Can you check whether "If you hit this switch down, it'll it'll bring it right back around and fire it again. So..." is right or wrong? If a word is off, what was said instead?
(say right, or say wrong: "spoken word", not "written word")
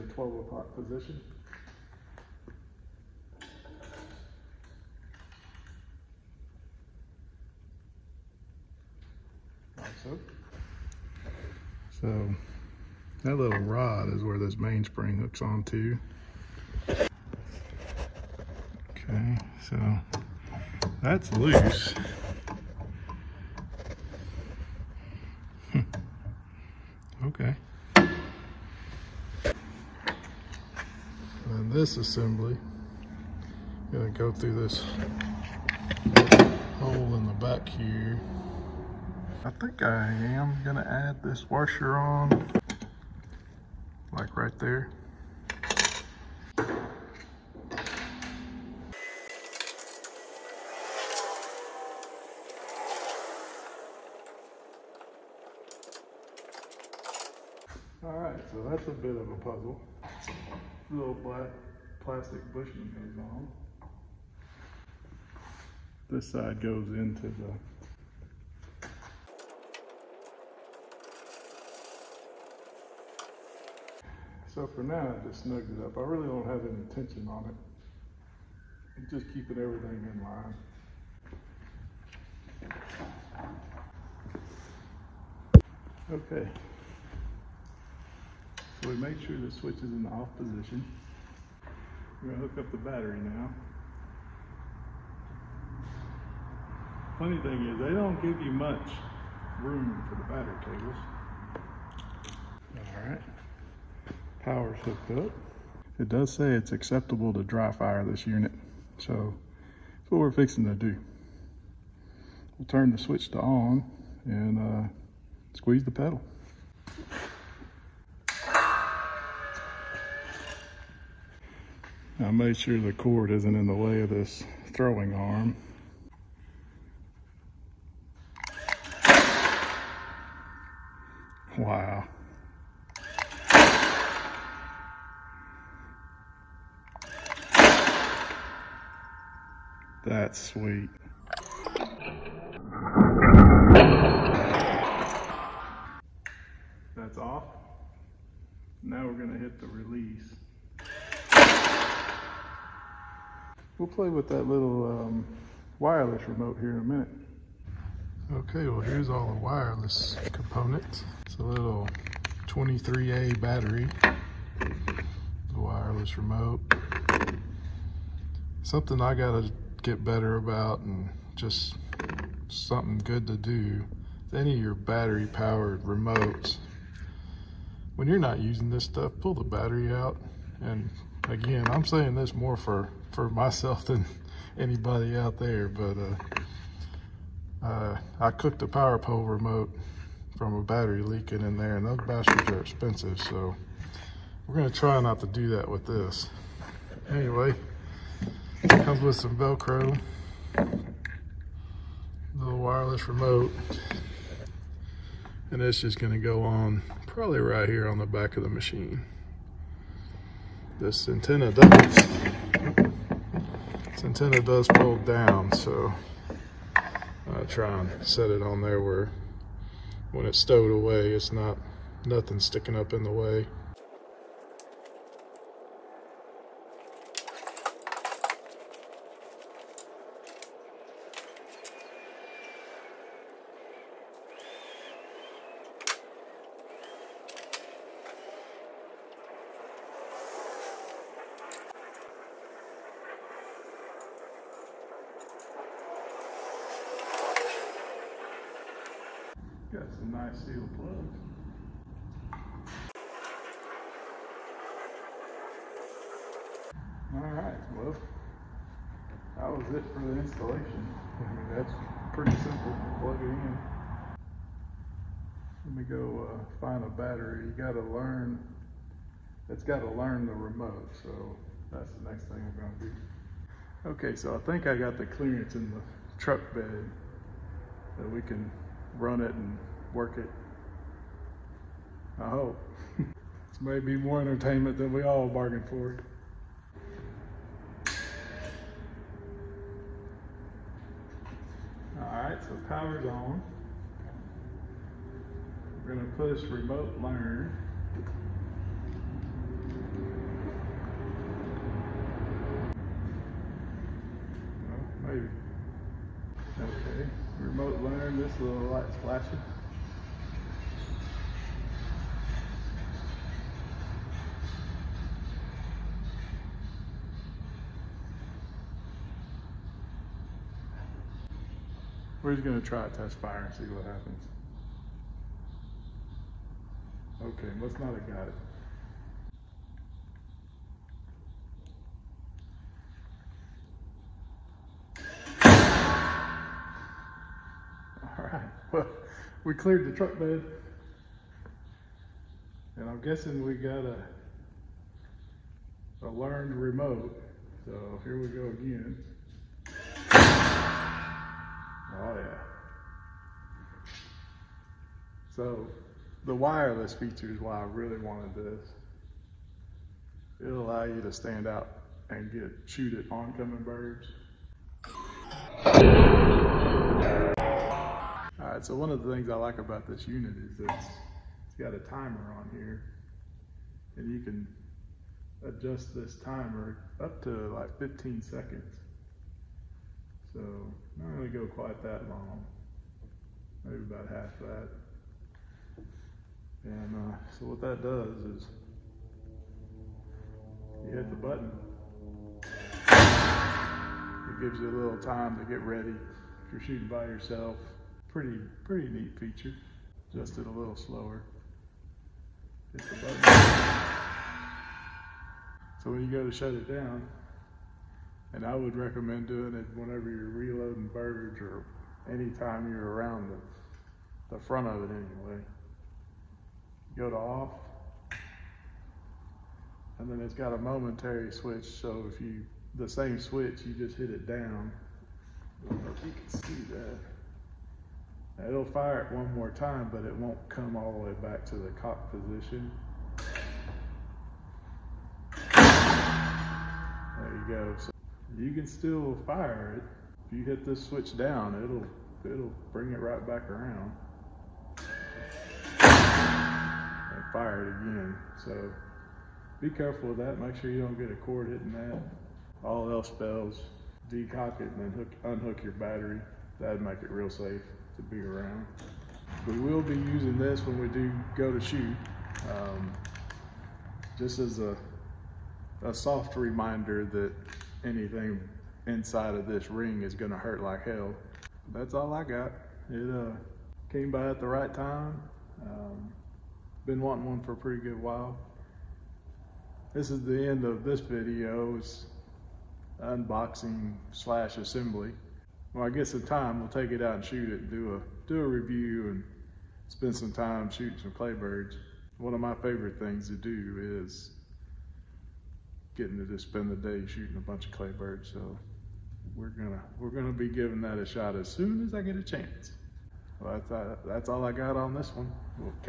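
right.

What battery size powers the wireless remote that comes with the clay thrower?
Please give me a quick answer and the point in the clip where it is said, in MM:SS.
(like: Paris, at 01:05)
23A, at 02:42.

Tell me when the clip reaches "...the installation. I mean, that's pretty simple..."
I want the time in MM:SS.
04:20.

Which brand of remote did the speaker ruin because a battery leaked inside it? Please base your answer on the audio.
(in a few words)
Power Pole.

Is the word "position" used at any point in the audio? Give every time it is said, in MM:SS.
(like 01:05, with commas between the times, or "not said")
00:00, 01:30, 07:12.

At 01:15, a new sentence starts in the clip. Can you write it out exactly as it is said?
I really don't have any tension on it.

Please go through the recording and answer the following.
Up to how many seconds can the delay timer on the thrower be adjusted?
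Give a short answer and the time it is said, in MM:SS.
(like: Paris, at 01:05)
15, at 06:17.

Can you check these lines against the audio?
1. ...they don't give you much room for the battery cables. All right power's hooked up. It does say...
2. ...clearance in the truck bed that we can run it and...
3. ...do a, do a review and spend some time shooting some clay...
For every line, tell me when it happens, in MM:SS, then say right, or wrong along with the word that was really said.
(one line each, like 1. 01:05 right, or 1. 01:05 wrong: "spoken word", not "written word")
1. 01:37 right
2. 04:35 right
3. 08:07 right.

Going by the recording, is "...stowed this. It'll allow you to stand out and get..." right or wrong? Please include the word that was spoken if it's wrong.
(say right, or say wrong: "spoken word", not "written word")
wrong: "wanted", not "stowed".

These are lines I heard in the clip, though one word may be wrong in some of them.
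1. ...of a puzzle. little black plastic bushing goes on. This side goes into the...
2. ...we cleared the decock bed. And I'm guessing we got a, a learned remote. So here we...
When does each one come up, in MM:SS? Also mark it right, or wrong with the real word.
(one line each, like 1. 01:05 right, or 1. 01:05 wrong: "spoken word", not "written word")
1. 00:59 right
2. 05:39 wrong: "truck", not "decock".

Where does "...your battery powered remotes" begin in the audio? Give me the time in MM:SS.
02:54.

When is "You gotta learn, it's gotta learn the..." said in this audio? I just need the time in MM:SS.
04:27.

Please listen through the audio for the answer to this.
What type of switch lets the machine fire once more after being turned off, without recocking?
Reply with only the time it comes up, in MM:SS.
07:00.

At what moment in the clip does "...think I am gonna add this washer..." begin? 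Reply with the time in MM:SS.
00:39.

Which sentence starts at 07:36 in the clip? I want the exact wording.
That'd make it real safe to be around.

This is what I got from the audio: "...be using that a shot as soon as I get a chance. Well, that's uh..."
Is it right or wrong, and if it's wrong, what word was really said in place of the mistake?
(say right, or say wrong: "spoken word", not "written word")
wrong: "giving", not "using".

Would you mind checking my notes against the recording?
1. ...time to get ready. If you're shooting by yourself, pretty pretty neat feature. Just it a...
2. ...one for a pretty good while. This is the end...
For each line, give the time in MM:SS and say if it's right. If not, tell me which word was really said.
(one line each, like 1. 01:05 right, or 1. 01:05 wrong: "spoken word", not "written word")
1. 06:35 right
2. 07:57 right.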